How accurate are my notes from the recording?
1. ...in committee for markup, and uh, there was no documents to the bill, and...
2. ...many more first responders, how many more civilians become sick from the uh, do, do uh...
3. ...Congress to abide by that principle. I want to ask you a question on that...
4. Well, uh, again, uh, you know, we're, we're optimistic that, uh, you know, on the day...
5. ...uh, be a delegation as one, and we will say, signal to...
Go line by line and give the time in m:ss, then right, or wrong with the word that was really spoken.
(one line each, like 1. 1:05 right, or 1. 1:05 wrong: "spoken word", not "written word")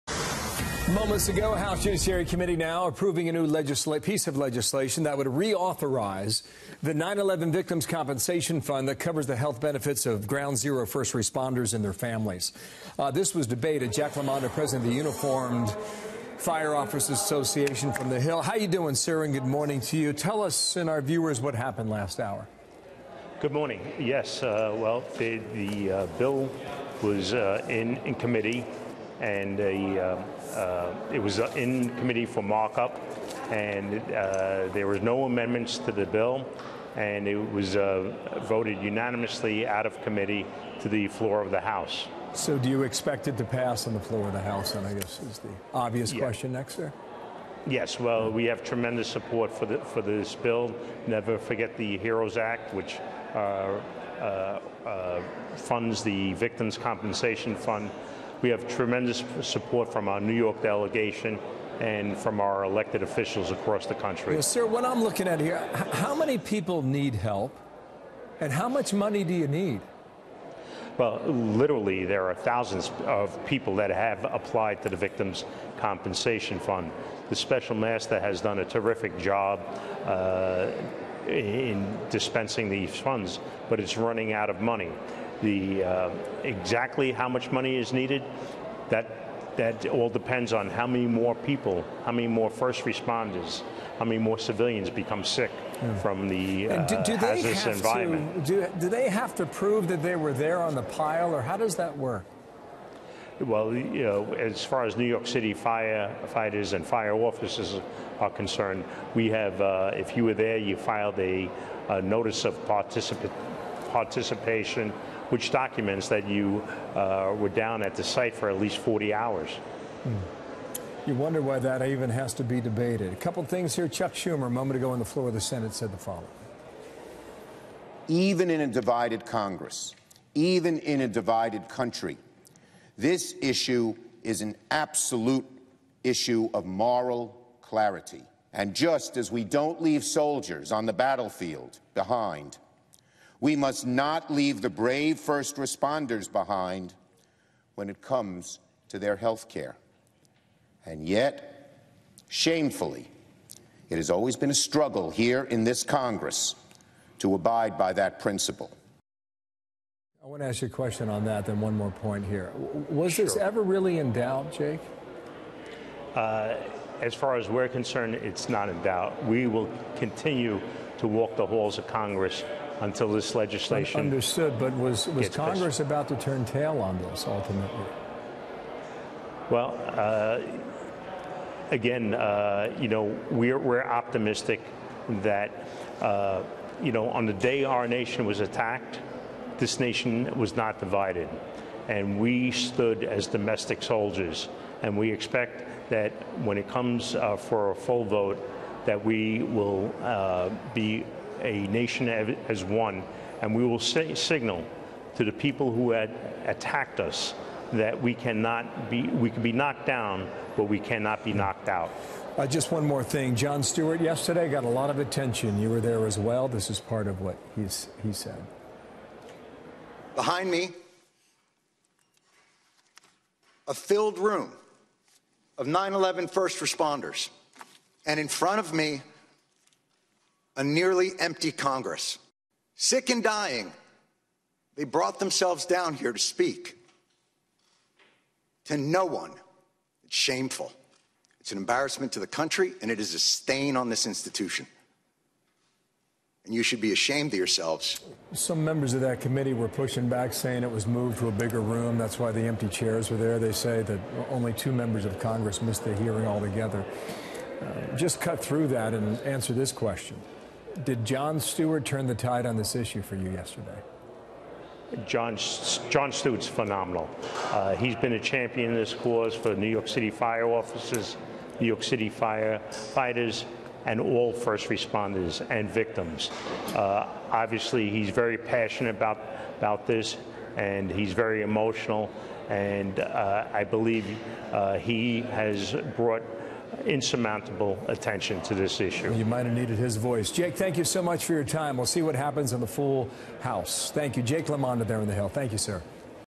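1. 0:31 wrong: "amendments", not "documents"
2. 1:32 right
3. 2:35 right
4. 2:59 right
5. 3:20 wrong: "nation", not "delegation".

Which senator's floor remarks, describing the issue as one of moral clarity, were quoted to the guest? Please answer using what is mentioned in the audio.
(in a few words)
Chuck Schumer.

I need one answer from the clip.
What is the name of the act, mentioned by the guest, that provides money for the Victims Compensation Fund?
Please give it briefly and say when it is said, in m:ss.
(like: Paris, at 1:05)
Never Forget the HEROES Act, at 0:51.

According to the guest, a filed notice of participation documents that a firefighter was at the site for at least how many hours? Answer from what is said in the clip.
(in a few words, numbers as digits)
40.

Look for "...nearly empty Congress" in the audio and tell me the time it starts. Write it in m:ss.
3:50.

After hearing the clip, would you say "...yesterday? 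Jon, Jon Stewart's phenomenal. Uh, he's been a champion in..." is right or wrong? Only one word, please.
right.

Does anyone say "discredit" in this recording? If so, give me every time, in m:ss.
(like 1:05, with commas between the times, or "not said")
not said.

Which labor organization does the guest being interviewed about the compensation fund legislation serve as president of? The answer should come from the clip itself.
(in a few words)
Uniformed Fire Officers Association.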